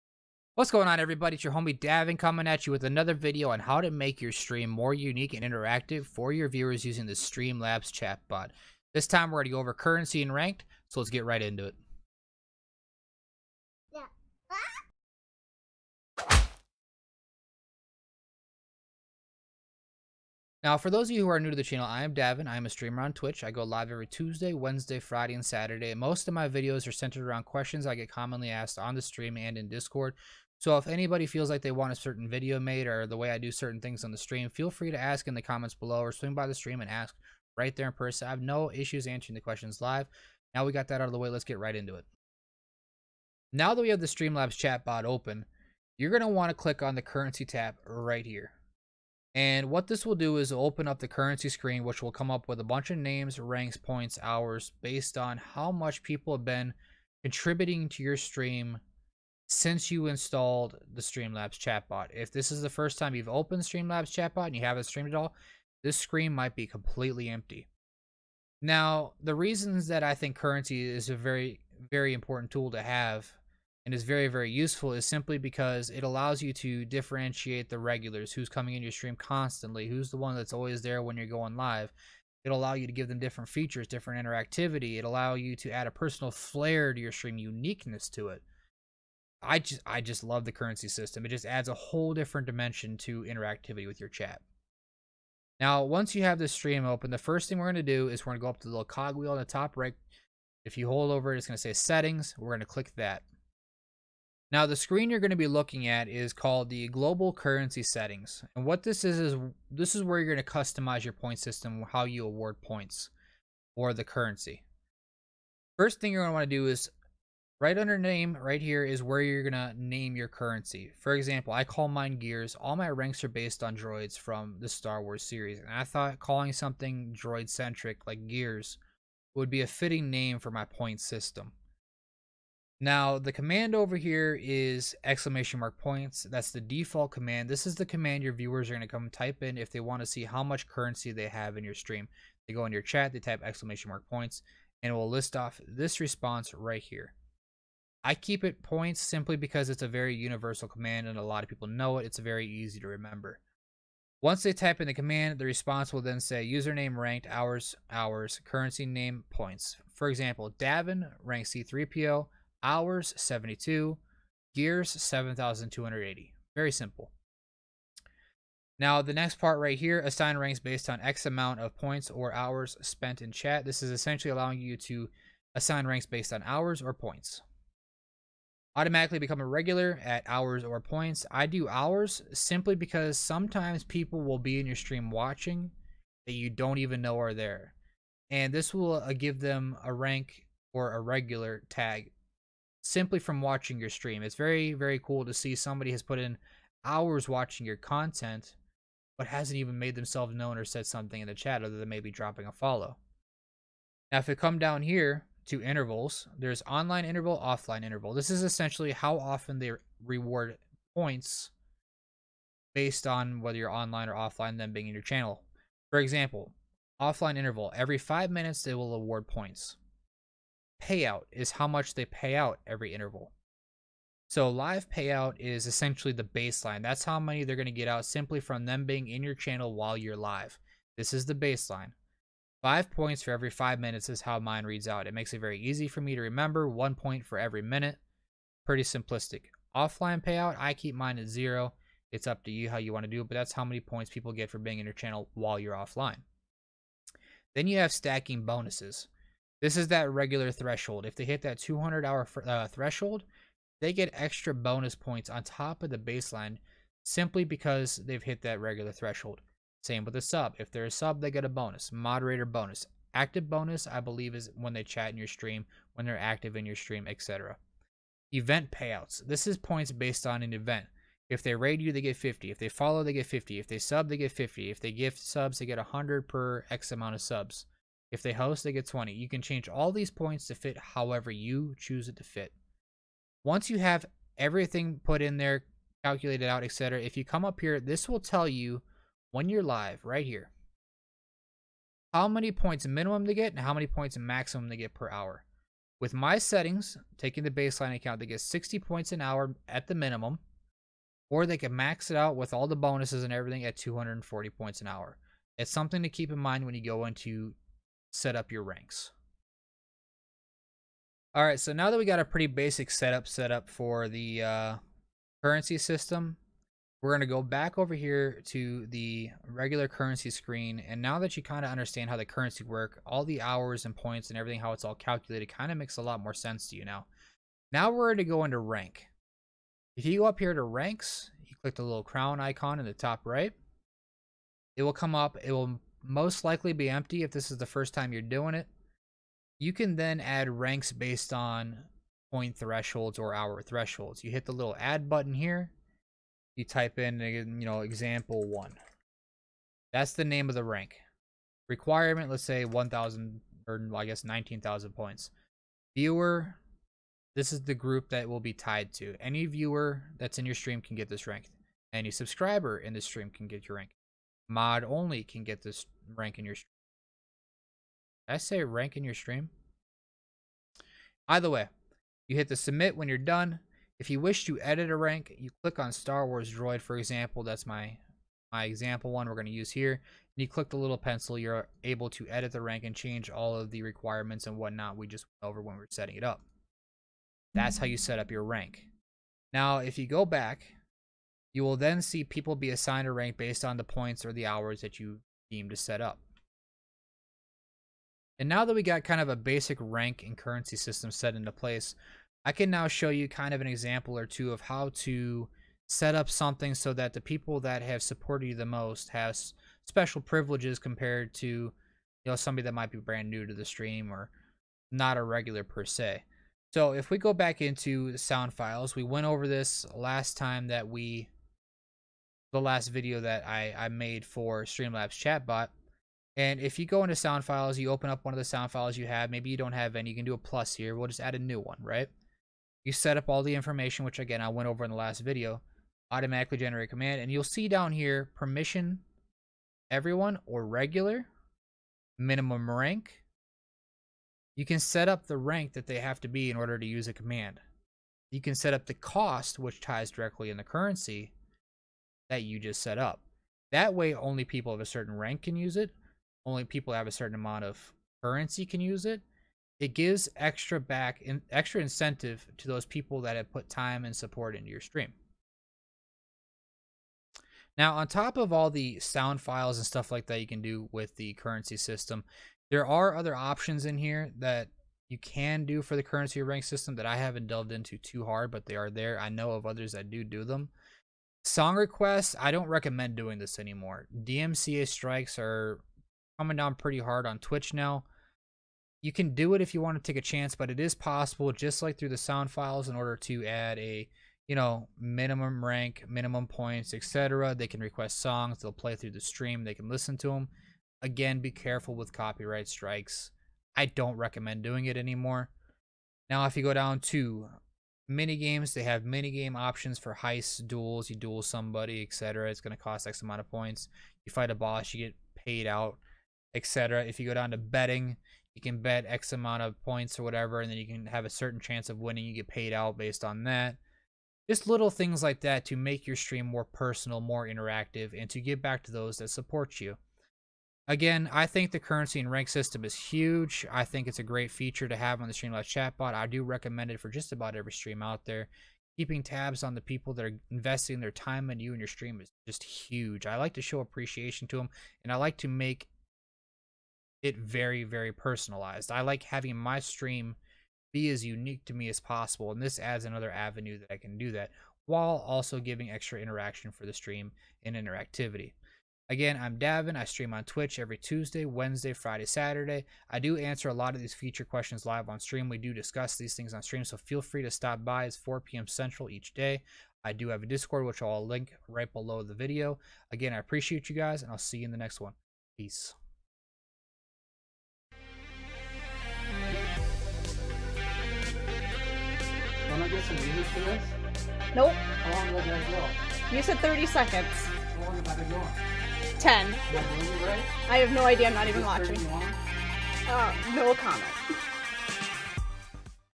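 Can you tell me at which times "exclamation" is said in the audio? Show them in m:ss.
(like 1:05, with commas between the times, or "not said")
2:15, 2:23.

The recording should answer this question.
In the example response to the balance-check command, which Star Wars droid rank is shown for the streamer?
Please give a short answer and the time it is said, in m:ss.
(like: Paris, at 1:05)
C3PO, at 2:41.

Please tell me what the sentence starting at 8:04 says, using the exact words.
DMCA strikes are coming down pretty hard on Twitch now.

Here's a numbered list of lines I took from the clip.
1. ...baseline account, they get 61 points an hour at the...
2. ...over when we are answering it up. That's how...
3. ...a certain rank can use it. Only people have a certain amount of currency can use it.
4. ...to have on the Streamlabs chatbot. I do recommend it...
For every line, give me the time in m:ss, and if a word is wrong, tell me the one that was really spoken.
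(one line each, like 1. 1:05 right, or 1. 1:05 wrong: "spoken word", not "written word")
1. 4:57 wrong: "60", not "61"
2. 6:25 wrong: "setting", not "answering"
3. 7:34 right
4. 8:54 right.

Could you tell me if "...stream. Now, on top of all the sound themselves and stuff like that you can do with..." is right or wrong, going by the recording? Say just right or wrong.
wrong.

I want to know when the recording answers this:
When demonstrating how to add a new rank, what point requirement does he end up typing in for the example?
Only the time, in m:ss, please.
5:54.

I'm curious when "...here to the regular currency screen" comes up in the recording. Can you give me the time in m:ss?
5:17.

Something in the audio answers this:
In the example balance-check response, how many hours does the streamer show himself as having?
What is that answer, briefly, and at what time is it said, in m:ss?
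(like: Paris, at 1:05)
72, at 2:42.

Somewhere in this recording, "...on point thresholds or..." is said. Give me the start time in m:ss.
5:41.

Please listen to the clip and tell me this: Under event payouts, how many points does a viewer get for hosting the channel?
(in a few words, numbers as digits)
20.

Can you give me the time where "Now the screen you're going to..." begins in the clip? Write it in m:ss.
1:44.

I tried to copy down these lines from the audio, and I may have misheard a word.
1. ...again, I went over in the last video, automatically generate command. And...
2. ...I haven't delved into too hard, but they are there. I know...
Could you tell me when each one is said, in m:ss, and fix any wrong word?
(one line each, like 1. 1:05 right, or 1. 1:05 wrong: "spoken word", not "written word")
1. 7:14 right
2. 7:57 right.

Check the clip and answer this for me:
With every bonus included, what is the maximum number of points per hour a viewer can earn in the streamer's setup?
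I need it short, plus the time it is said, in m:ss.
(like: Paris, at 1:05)
240, at 5:03.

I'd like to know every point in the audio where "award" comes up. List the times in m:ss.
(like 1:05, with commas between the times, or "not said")
1:52, 3:38.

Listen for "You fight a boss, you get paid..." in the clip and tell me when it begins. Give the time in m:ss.
8:34.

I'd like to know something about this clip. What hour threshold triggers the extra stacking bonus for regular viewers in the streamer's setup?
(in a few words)
200.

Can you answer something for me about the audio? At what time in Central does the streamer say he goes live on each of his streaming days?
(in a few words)
4 p.m.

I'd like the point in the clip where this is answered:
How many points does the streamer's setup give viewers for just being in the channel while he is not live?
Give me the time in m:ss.
4:00.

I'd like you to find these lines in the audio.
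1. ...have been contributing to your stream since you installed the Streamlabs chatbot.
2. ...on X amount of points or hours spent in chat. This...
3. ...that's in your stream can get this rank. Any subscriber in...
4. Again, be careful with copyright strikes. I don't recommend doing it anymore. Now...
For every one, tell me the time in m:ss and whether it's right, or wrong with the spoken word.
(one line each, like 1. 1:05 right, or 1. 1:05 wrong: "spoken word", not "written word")
1. 0:56 right
2. 2:50 right
3. 6:00 right
4. 8:21 right.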